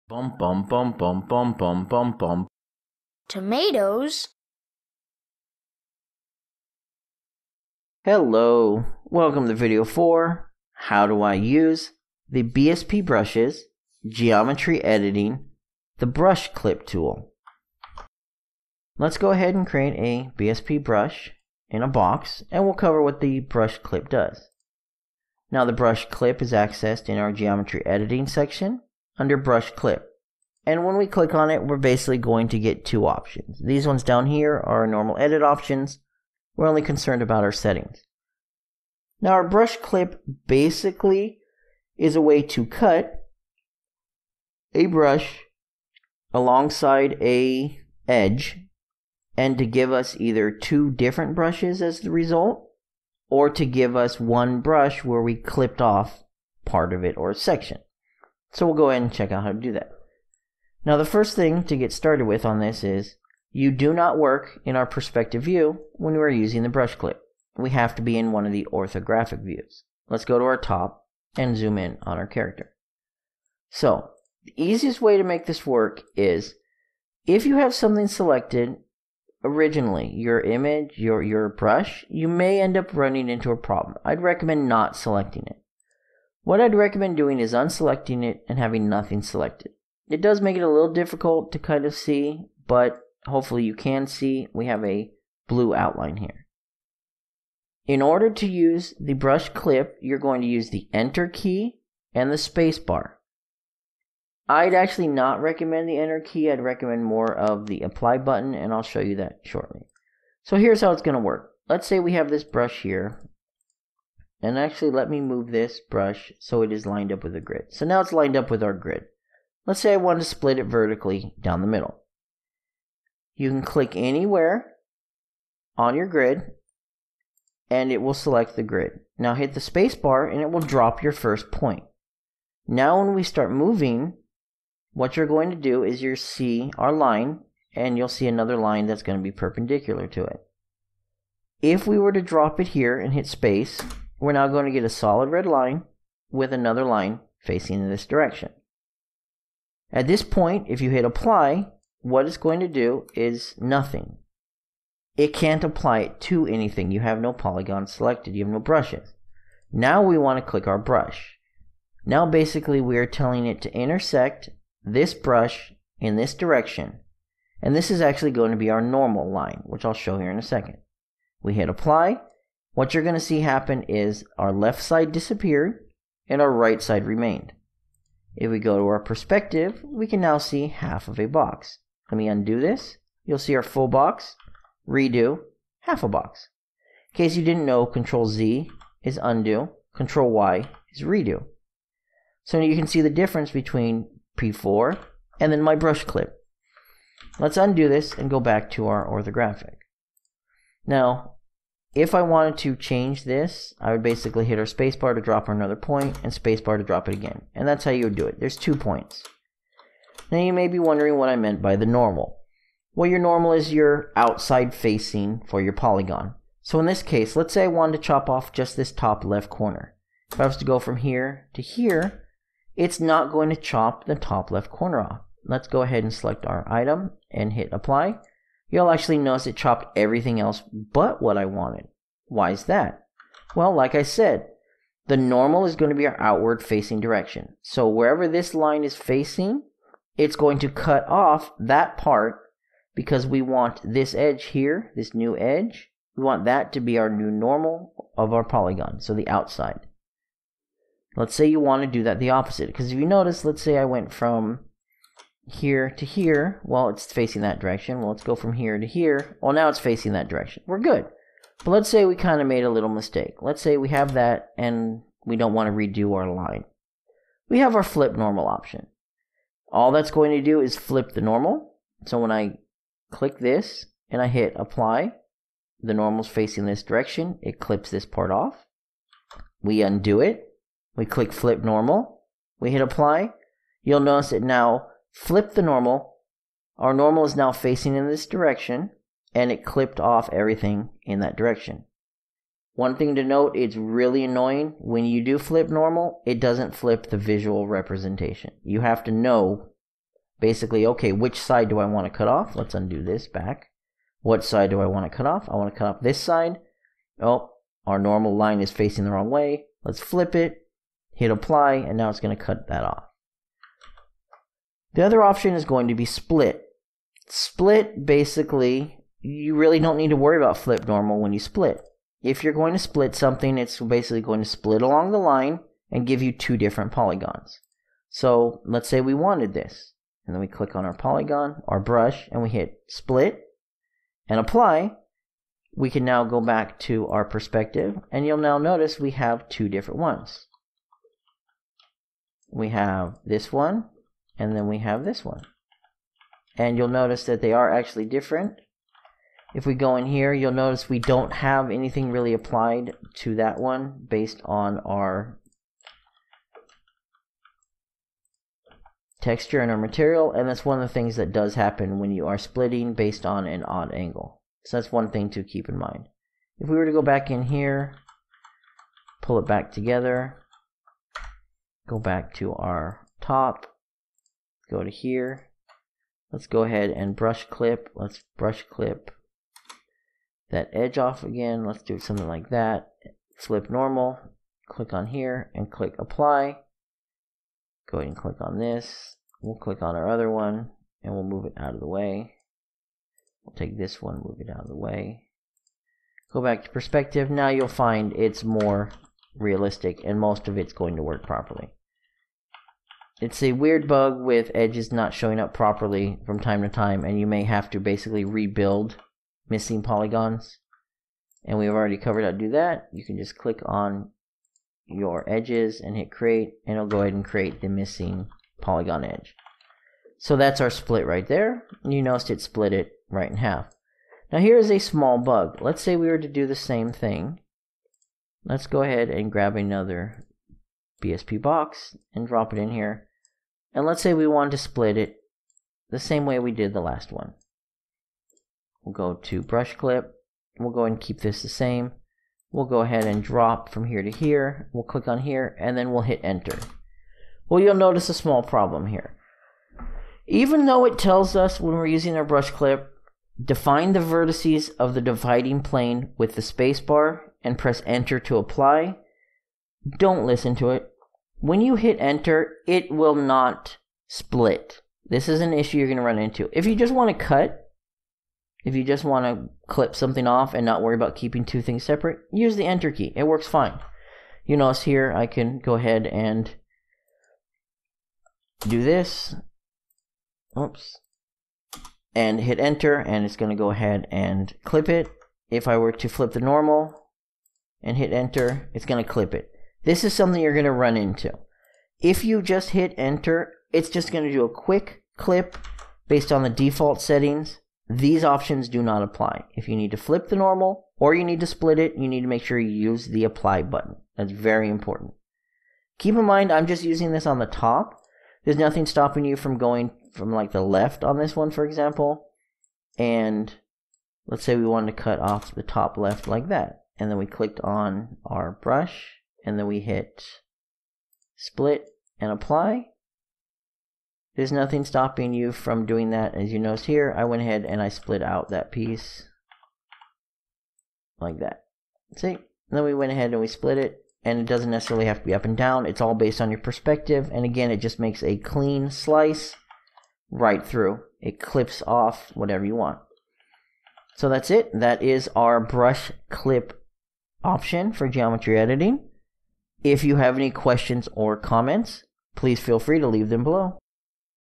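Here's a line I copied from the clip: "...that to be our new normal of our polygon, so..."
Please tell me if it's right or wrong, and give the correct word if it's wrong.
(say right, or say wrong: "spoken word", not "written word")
right.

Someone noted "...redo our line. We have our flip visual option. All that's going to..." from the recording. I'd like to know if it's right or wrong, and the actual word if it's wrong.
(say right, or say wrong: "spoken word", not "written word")
wrong: "normal", not "visual".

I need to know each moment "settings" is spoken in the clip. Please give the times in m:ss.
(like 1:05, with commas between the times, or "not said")
0:37, 8:17.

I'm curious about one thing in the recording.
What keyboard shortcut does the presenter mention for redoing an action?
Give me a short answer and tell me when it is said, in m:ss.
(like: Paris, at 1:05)
Control Y, at 3:09.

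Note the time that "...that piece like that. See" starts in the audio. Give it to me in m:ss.
8:48.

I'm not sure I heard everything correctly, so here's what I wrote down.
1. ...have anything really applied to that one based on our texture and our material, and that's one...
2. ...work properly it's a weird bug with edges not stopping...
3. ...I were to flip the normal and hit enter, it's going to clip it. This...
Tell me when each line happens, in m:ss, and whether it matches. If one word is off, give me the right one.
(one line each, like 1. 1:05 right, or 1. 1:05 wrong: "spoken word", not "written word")
1. 5:51 right
2. 6:41 wrong: "showing", not "stopping"
3. 8:05 right.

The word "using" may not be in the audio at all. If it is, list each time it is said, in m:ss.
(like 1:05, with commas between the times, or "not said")
1:06, 7:31, 8:26.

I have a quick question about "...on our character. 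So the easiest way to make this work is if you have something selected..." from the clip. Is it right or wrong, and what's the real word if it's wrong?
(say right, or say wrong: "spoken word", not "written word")
right.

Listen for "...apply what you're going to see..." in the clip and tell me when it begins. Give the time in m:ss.
2:51.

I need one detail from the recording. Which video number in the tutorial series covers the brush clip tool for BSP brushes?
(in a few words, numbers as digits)
4.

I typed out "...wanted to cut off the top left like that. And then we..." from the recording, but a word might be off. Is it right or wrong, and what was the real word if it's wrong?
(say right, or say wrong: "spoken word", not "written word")
right.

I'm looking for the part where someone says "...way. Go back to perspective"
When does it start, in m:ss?
6:34.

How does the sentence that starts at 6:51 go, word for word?
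And we've already covered how to do that.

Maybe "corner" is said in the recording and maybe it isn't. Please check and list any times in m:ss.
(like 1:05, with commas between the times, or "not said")
3:39, 3:44.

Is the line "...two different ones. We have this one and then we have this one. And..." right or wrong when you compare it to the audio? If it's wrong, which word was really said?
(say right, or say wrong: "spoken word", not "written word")
right.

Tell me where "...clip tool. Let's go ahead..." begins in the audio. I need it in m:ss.
0:16.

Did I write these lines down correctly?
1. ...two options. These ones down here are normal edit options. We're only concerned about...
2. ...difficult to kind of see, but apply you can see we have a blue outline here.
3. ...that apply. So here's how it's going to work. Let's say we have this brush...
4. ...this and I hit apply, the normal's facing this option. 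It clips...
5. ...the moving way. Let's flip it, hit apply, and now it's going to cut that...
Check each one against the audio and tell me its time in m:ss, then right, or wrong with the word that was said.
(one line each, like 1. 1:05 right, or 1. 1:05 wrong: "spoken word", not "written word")
1. 0:32 right
2. 1:30 wrong: "hopefully", not "apply"
3. 1:49 wrong: "shortly", not "apply"
4. 4:33 wrong: "direction", not "option"
5. 5:09 wrong: "wrong", not "moving".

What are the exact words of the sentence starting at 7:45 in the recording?
This is an issue you're going to run into.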